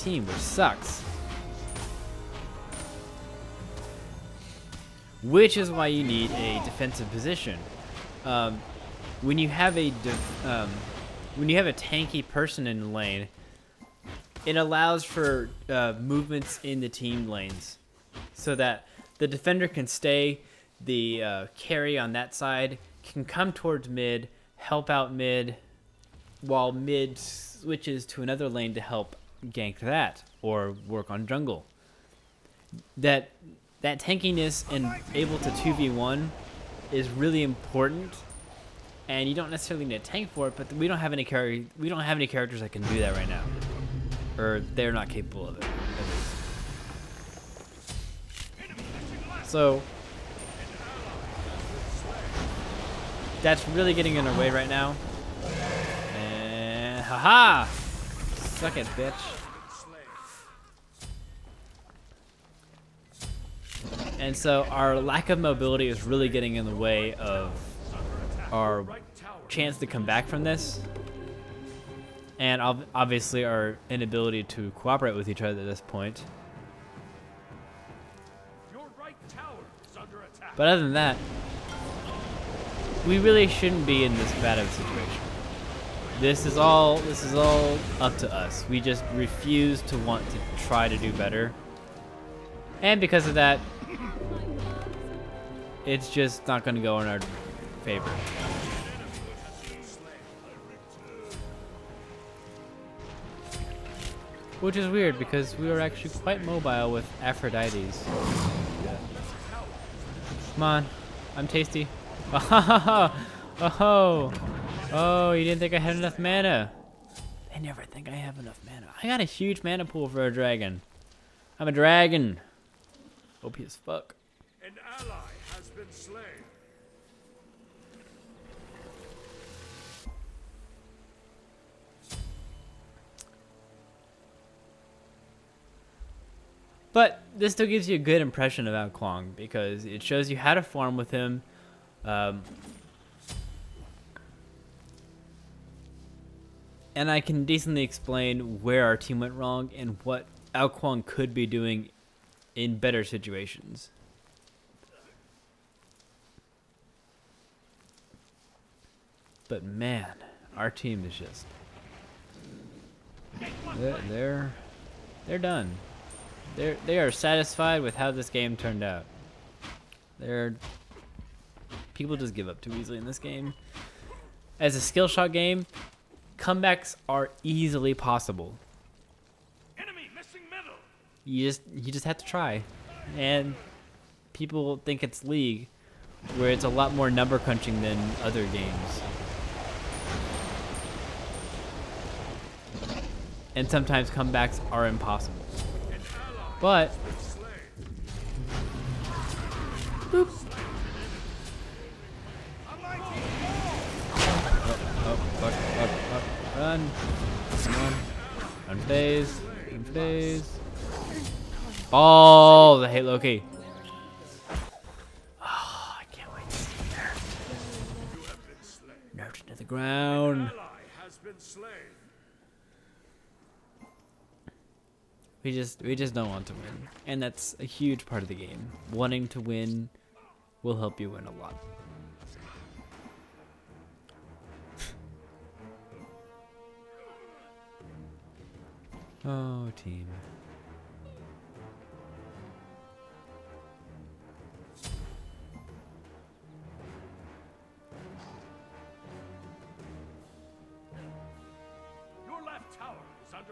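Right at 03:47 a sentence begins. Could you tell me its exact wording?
And that's a huge part of the game.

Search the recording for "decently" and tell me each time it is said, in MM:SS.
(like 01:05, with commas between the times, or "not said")
02:27.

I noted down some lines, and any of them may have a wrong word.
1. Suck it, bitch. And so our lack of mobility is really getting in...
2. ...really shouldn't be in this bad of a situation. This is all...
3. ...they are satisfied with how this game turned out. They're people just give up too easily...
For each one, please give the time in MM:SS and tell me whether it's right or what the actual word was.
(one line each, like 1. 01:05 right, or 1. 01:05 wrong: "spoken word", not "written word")
1. 00:58 right
2. 01:23 right
3. 02:46 right.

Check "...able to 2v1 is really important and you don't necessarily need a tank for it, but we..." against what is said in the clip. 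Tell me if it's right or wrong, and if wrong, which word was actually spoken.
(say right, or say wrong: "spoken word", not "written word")
right.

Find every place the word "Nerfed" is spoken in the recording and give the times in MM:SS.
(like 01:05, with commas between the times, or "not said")
03:39.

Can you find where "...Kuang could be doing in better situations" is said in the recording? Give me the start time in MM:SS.
02:30.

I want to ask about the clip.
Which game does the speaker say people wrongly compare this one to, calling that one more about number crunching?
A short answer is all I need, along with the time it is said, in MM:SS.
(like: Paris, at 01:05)
League, at 03:05.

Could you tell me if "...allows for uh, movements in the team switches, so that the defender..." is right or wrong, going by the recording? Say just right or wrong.
wrong.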